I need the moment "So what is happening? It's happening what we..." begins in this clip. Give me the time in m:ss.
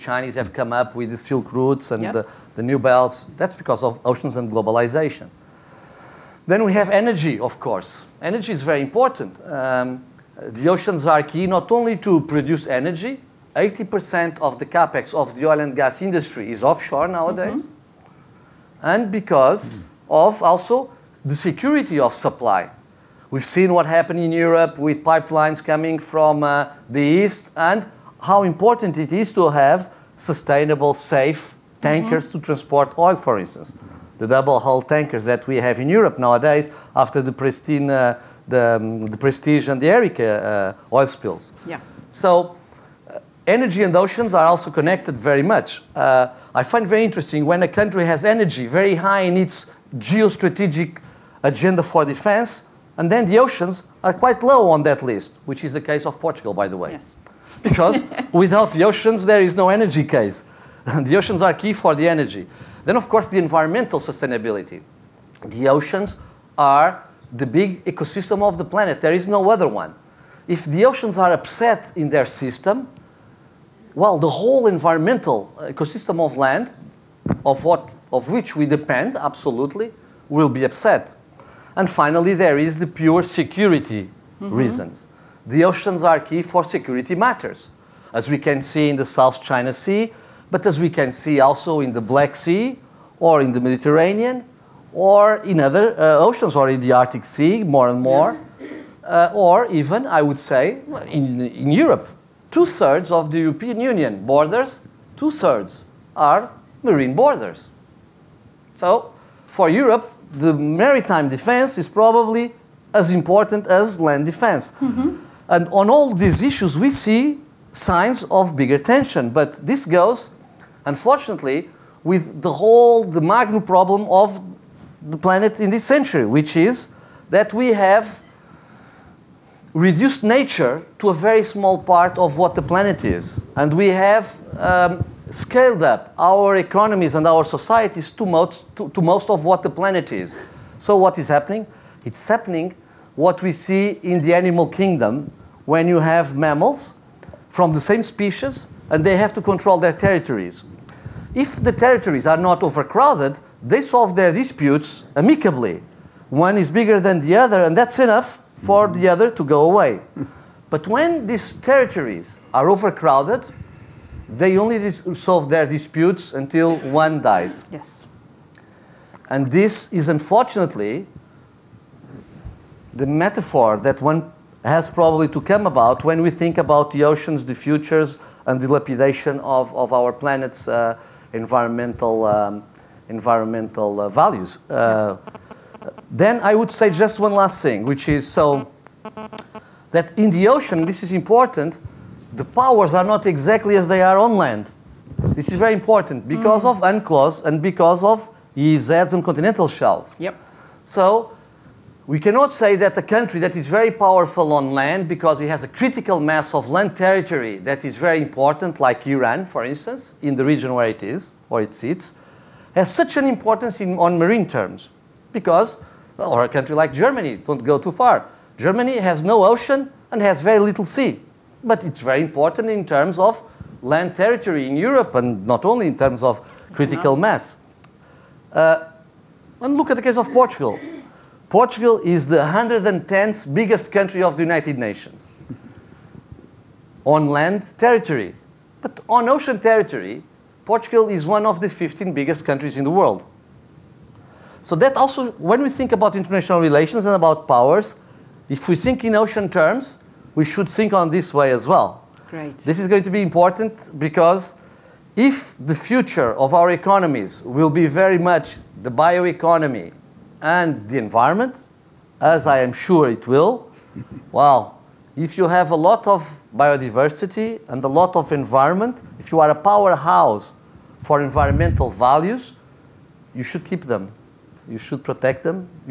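2:20.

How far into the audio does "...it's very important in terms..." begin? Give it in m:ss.
3:41.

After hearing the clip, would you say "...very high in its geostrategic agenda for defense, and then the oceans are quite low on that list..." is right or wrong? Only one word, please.
right.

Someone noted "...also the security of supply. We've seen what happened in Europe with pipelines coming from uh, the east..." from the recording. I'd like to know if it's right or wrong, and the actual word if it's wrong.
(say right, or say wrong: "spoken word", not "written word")
right.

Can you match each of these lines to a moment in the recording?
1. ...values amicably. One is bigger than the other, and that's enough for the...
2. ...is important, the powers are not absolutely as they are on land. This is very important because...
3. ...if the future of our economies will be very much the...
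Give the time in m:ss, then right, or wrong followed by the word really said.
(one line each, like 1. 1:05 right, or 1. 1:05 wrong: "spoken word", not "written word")
1. 2:34 wrong: "disputes", not "values"
2. 3:11 wrong: "exactly", not "absolutely"
3. 4:15 right.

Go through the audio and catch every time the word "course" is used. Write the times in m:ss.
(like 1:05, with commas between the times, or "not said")
0:07, 1:03.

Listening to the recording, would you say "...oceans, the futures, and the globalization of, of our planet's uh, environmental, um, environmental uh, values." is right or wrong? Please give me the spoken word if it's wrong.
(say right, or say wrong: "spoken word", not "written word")
wrong: "lapidation", not "globalization".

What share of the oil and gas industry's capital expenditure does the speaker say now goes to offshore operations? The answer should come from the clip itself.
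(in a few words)
80%.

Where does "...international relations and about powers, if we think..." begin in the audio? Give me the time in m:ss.
4:06.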